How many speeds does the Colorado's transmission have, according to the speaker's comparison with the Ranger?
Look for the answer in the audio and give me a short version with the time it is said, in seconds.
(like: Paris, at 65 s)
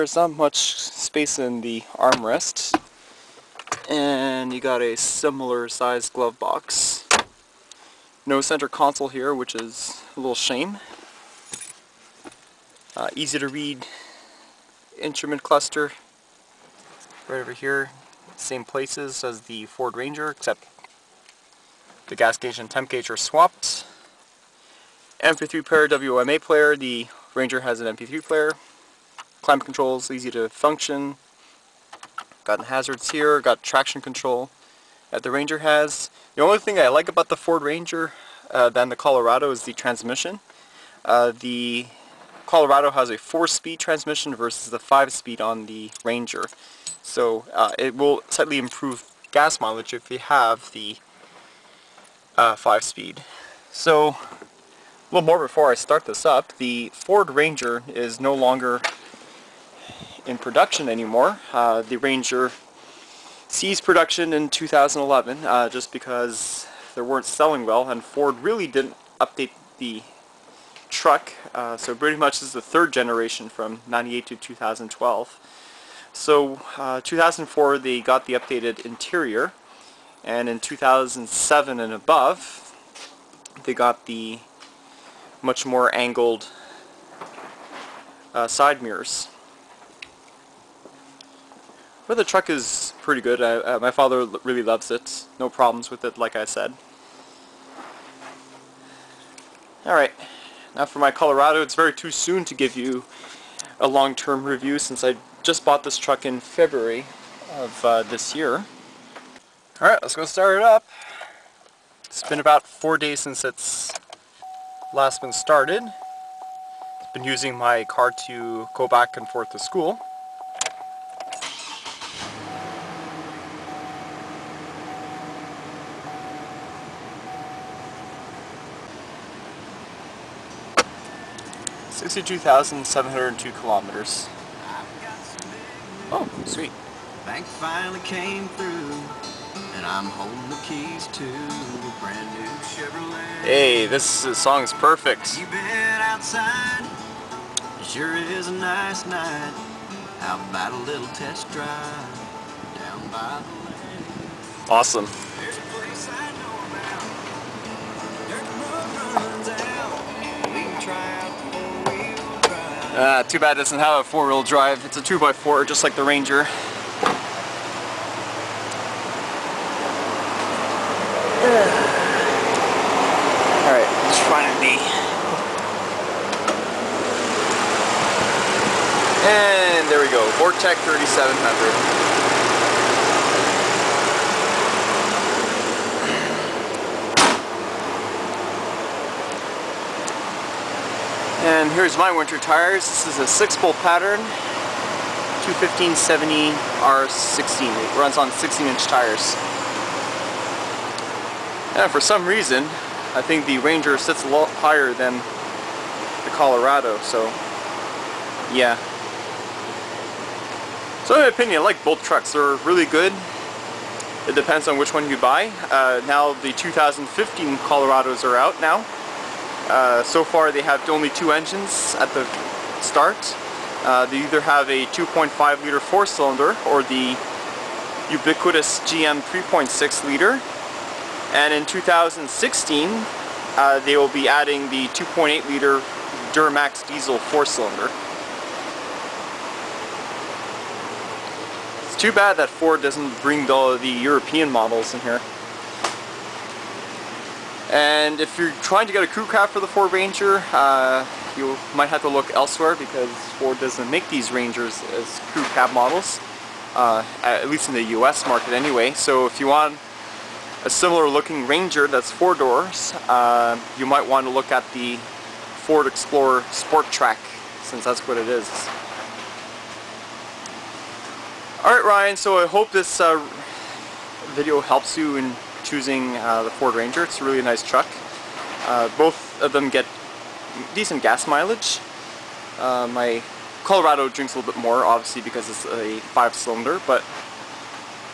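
4, at 43 s.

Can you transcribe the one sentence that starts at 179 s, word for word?
And there we go, Vortec 3700.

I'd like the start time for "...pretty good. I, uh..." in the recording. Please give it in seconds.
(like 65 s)
93 s.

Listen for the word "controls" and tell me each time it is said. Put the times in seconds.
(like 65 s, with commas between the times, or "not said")
29 s, 34 s.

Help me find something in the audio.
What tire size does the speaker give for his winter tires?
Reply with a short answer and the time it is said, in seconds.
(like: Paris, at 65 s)
215 70 R16, at 195 s.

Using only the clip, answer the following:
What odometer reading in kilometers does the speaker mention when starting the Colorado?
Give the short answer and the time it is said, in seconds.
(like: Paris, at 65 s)
62,702, at 131 s.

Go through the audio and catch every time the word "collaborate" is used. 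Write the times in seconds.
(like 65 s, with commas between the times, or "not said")
not said.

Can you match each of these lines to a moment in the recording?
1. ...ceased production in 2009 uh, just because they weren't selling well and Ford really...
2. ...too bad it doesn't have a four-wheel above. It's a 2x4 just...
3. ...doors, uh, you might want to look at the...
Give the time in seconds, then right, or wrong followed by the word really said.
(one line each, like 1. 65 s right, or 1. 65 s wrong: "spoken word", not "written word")
1. 63 s wrong: "2011", not "2009"
2. 163 s wrong: "drive", not "above"
3. 262 s right.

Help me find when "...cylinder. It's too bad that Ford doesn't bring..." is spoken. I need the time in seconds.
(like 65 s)
237 s.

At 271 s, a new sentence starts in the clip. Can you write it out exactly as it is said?
Alright Ryan, so I hope this uh, video helps you in choosing uh, the Ford Ranger.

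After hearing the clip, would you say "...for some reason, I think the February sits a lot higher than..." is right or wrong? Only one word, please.
wrong.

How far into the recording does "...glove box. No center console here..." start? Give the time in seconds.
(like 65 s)
6 s.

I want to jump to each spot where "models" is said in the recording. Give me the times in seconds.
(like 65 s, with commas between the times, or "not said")
244 s, 255 s.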